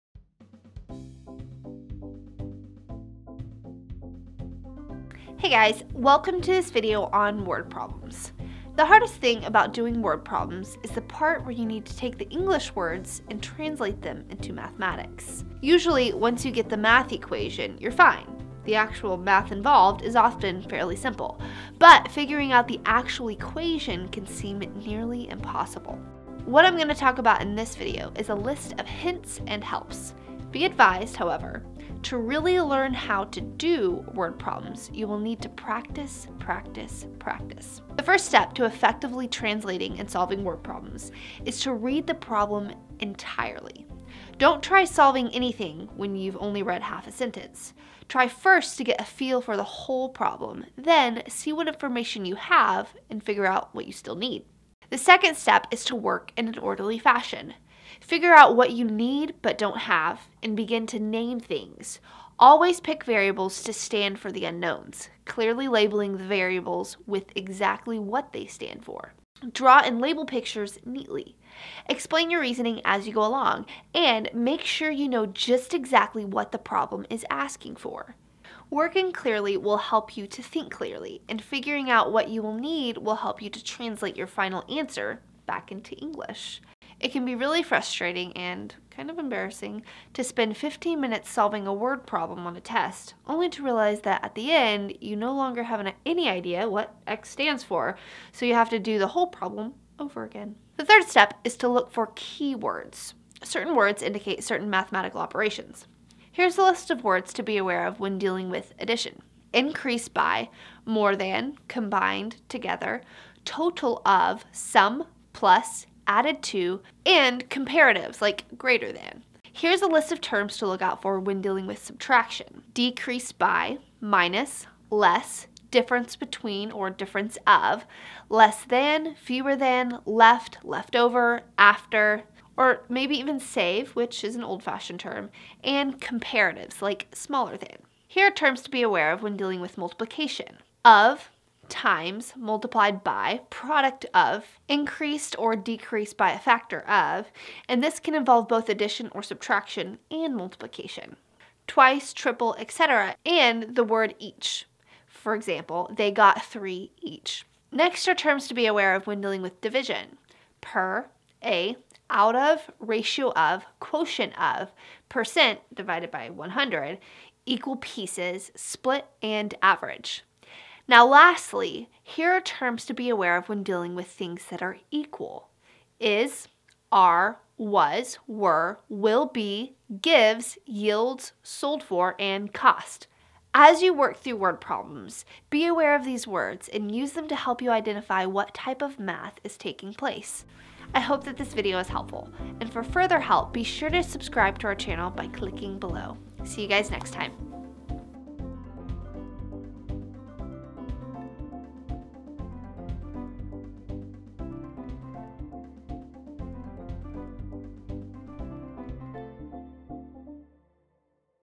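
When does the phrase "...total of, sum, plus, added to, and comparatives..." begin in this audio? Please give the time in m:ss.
1:53.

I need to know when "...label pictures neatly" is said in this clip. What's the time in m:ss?
1:10.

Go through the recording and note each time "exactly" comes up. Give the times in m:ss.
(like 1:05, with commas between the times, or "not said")
1:07, 1:15.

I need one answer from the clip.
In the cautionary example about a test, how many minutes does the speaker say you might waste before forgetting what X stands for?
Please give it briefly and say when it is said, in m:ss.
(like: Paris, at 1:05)
15, at 1:30.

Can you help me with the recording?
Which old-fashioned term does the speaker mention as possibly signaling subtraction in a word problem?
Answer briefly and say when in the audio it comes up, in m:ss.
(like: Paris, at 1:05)
save, at 2:13.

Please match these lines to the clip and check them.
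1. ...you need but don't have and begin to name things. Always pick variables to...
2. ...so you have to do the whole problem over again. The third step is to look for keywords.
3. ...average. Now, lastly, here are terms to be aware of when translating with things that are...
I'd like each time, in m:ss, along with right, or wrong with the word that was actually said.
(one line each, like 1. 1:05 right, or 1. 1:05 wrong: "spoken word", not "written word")
1. 0:58 right
2. 1:38 right
3. 2:49 wrong: "dealing", not "translating".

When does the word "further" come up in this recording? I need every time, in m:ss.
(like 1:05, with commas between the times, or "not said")
3:12.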